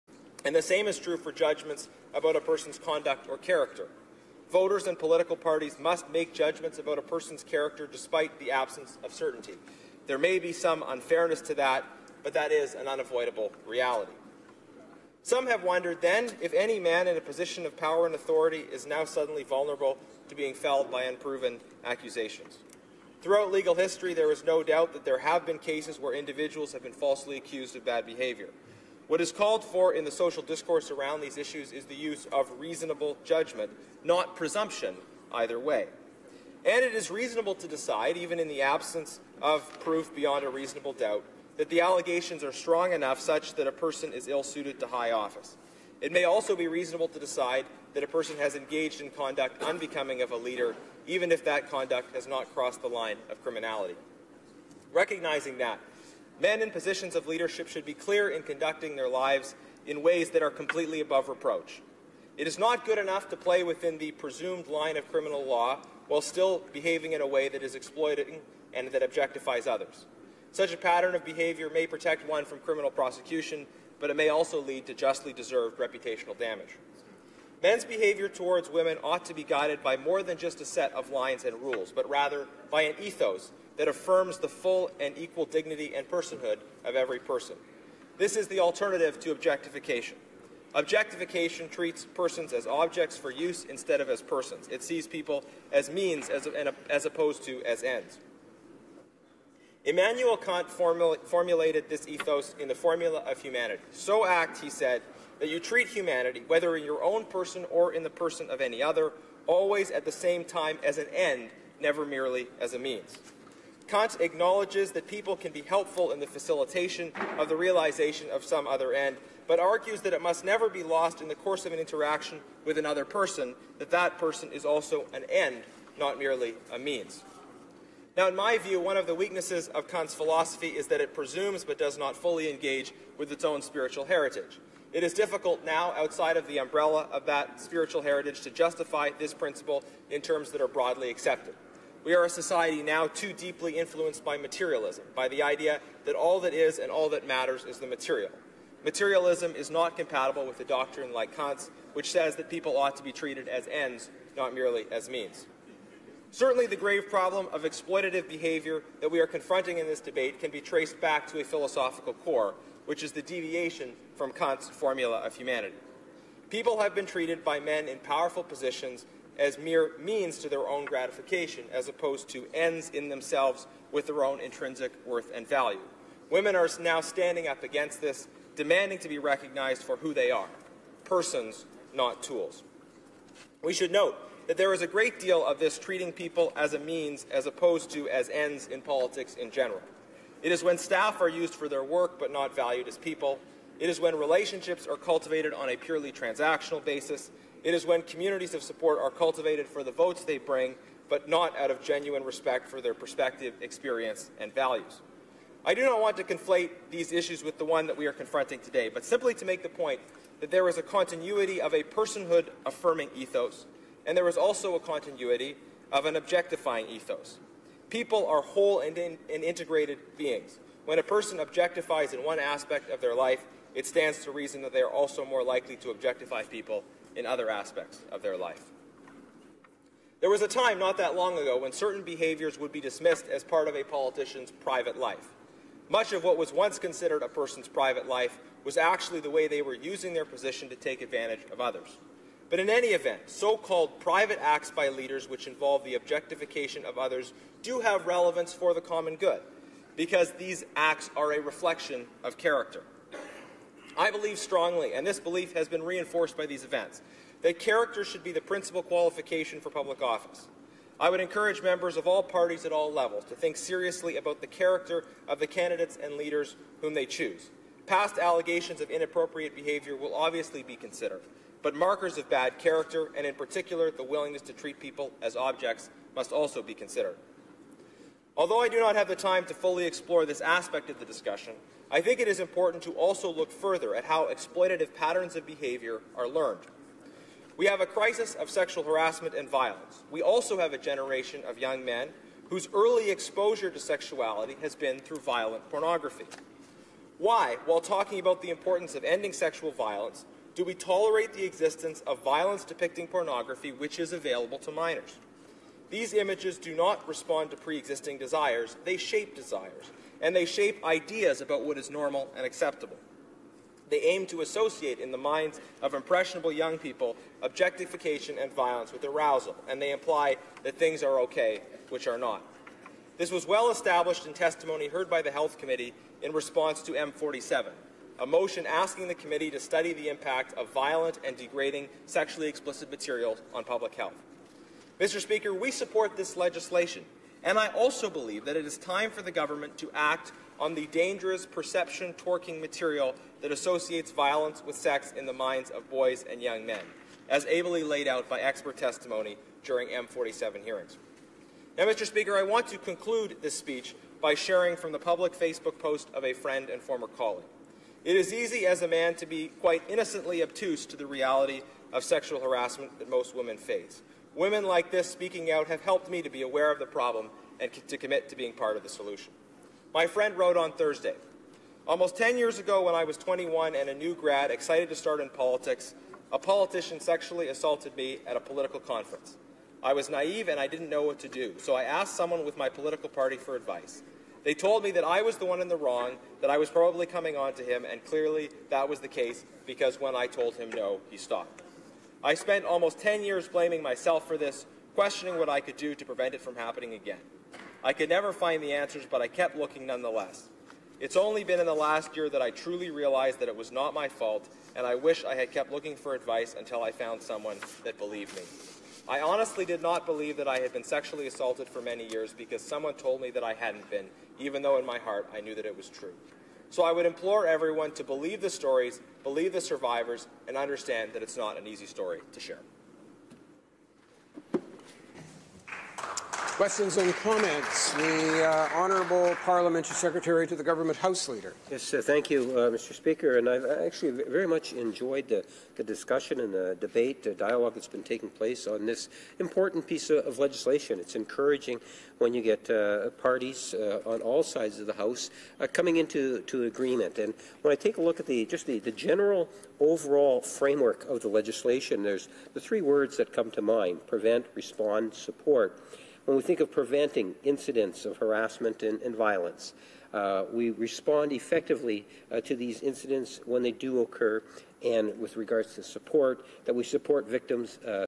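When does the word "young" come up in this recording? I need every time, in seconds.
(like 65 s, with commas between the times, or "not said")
291 s, 316 s, 346 s.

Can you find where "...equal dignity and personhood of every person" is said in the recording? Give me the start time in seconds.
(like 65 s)
85 s.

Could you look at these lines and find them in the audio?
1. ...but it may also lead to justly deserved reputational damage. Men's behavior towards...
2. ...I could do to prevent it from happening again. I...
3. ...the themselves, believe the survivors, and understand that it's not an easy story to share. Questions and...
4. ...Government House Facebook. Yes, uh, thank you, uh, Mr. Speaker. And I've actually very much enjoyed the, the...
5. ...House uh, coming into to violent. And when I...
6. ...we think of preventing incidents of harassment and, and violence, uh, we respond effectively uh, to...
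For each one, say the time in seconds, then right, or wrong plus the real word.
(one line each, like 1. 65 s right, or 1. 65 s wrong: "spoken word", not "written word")
1. 73 s right
2. 395 s right
3. 418 s wrong: "stories", not "themselves"
4. 430 s wrong: "Leader", not "Facebook"
5. 444 s wrong: "agreement", not "violent"
6. 456 s right.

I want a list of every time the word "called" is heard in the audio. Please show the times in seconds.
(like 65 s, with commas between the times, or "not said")
29 s, 243 s.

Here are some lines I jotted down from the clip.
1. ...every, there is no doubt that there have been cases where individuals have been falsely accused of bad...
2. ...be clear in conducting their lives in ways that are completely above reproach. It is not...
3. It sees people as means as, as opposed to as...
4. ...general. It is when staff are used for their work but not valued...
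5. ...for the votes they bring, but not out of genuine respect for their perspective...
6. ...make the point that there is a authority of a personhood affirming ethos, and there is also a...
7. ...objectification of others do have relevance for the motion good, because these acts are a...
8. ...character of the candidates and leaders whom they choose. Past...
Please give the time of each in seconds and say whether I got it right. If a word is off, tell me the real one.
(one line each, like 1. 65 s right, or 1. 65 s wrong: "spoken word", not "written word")
1. 23 s wrong: "history", not "every"
2. 57 s right
3. 94 s right
4. 189 s right
5. 199 s right
6. 209 s wrong: "continuity", not "authority"
7. 245 s wrong: "common", not "motion"
8. 264 s right.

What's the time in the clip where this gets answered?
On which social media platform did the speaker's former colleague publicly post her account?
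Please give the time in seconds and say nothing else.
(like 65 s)
355 s.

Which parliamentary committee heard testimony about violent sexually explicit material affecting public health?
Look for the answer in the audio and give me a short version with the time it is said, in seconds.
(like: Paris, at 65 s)
Health Committee, at 325 s.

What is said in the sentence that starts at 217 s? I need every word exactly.
People are whole and, in, and integrated beings.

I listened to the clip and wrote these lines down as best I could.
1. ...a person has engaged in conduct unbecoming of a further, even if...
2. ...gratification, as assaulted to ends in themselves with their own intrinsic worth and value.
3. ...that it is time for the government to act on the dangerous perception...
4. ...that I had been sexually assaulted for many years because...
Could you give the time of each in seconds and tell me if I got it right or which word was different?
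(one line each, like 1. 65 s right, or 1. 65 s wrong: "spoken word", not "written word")
1. 48 s wrong: "leader", not "further"
2. 170 s wrong: "opposed", not "assaulted"
3. 338 s right
4. 410 s right.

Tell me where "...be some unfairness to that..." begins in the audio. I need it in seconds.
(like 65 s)
10 s.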